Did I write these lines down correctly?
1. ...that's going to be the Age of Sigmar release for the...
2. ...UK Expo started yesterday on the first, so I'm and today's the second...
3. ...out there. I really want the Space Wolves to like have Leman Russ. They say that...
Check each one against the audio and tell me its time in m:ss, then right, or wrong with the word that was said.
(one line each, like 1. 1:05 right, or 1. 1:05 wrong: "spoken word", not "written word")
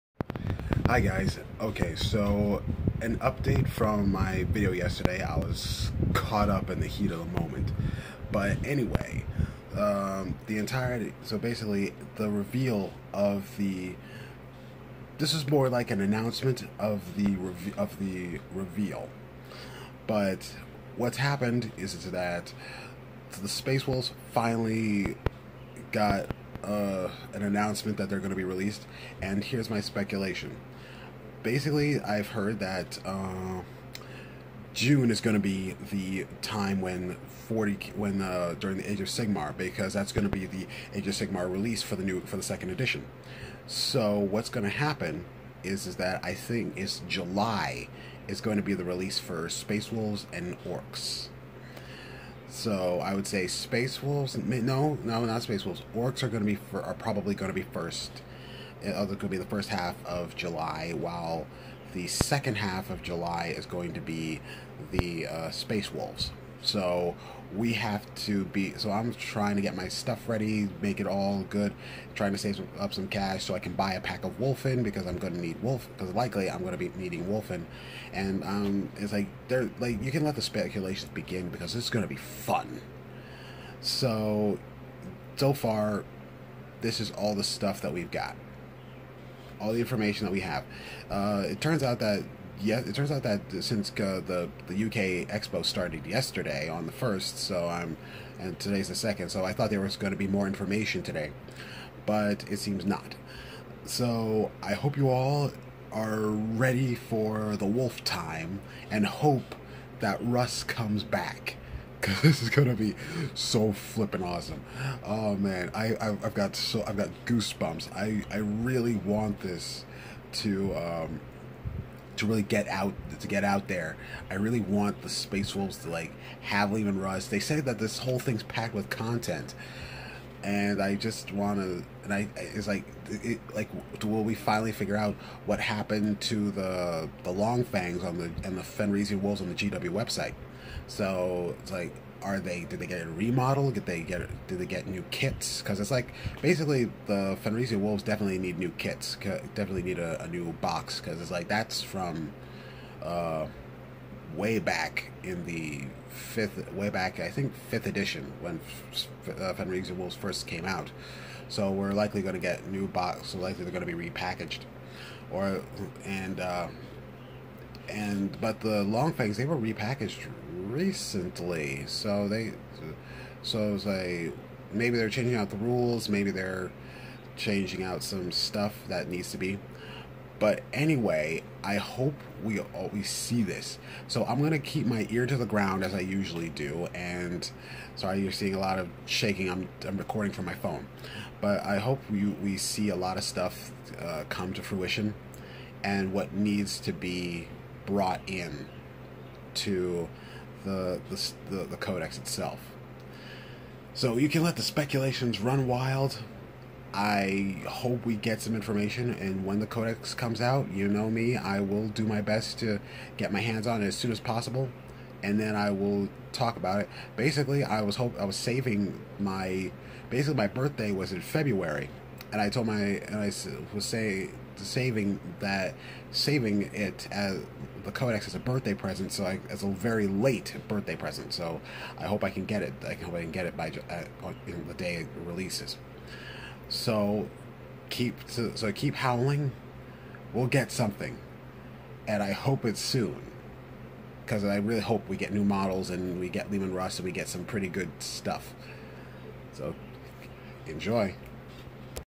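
1. 0:39 right
2. 1:34 right
3. 2:03 right.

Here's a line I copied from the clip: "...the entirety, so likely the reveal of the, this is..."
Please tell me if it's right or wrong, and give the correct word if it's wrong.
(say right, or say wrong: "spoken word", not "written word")
wrong: "basically", not "likely".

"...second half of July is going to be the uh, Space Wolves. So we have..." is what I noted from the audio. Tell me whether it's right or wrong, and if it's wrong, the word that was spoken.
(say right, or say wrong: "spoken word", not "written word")
right.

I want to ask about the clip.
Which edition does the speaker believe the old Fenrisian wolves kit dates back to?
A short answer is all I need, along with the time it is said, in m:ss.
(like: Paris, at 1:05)
Fifth edition, at 2:37.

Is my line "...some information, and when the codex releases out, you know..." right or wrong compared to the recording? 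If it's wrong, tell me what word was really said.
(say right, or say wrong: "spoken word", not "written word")
wrong: "comes", not "releases".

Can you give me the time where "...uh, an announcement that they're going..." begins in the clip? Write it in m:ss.
0:26.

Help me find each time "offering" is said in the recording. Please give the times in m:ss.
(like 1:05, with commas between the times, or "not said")
not said.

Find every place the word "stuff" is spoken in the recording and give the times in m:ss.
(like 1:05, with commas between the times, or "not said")
1:09, 1:27, 2:58, 3:13, 4:07.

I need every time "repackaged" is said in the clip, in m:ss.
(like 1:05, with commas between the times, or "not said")
2:44, 2:49.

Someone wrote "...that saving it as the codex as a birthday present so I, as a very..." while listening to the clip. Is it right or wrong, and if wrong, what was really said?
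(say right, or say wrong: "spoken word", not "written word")
right.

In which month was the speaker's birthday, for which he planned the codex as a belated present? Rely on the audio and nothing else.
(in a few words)
February.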